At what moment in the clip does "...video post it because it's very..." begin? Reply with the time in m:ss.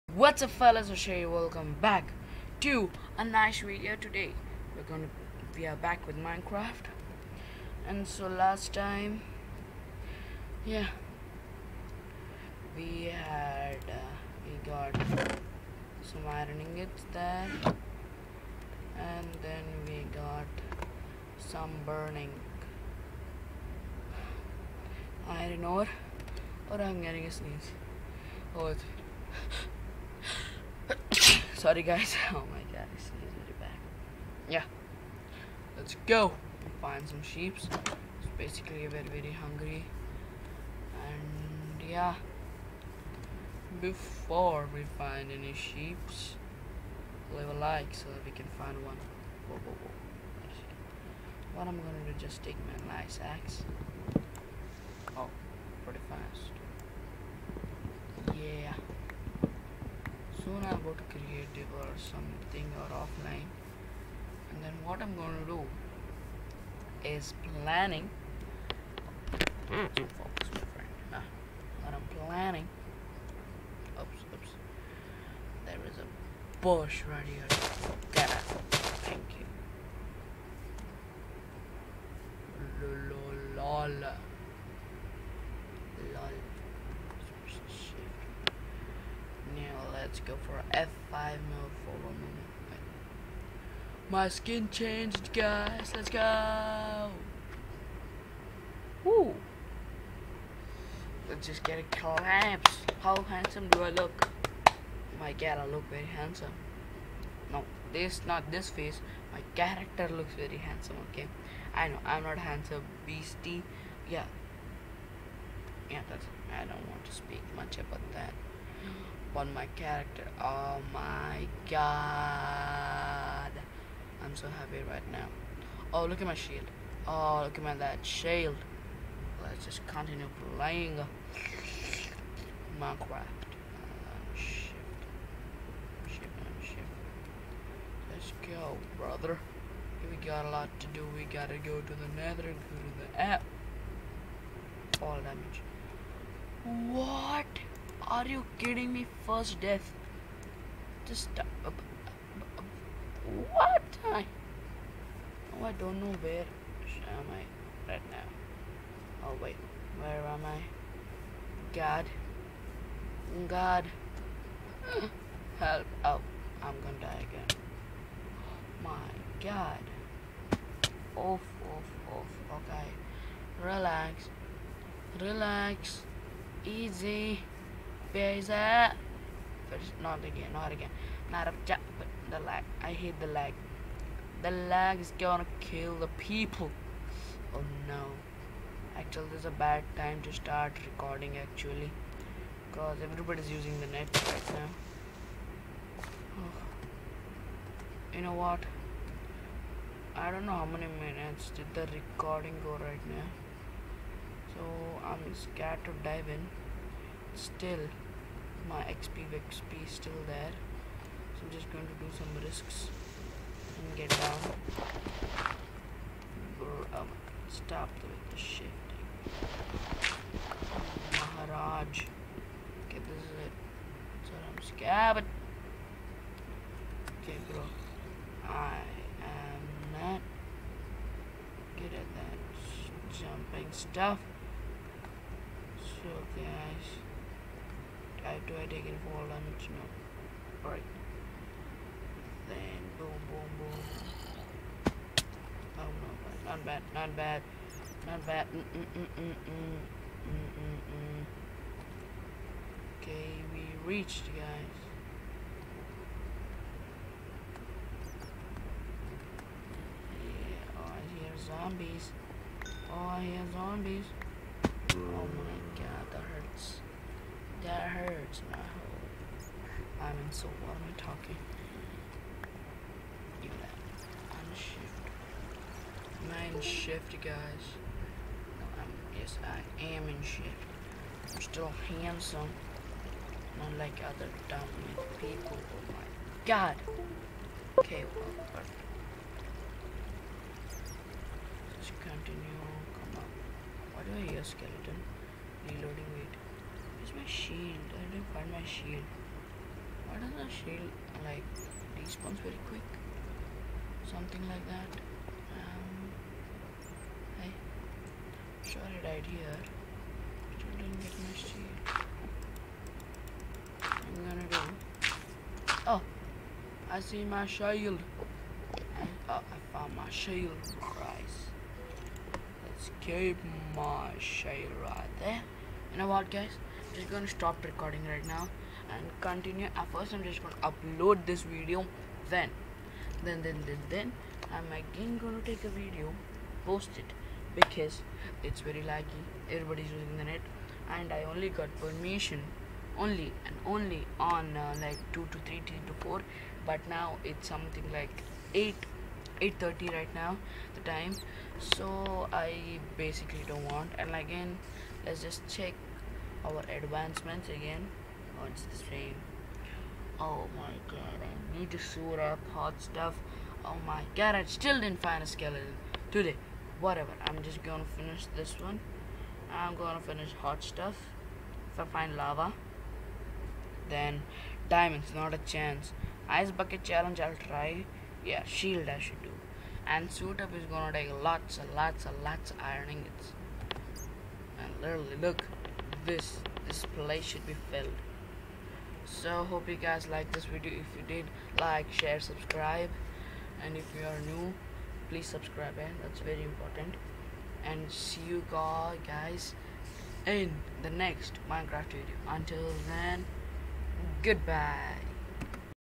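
5:35.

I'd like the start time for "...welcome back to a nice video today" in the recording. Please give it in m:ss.
0:01.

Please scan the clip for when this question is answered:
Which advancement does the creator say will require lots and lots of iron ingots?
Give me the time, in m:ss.
6:20.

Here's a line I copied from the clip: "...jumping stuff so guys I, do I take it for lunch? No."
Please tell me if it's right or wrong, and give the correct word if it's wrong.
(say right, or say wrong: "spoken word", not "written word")
right.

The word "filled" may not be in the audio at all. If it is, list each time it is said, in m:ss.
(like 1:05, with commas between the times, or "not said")
6:27.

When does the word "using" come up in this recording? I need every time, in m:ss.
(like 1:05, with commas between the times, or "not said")
3:13, 5:39.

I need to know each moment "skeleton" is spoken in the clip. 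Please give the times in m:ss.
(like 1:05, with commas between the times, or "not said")
4:54, 6:05.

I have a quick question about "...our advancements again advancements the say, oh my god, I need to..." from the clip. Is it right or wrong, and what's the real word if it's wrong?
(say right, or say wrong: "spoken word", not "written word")
wrong: "wants", not "advancements".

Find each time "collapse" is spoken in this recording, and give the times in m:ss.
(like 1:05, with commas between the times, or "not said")
1:41.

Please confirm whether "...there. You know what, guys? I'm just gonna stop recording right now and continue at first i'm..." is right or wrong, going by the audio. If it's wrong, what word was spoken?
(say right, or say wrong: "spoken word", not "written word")
right.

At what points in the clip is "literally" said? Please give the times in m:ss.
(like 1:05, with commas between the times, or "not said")
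6:24.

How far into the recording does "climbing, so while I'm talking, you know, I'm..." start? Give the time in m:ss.
4:30.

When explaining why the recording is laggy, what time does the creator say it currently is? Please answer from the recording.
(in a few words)
8:30.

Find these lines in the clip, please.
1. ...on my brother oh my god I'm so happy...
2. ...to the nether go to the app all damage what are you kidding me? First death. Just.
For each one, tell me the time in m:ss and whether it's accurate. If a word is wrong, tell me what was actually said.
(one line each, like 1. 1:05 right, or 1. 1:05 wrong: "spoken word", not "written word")
1. 1:59 wrong: "character", not "brother"
2. 2:21 right.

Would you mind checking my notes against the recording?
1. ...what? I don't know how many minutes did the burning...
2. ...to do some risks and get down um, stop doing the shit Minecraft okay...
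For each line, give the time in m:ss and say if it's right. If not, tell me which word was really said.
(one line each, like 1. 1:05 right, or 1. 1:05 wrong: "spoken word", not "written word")
1. 3:18 wrong: "recording", not "burning"
2. 3:31 wrong: "Maharaj", not "Minecraft".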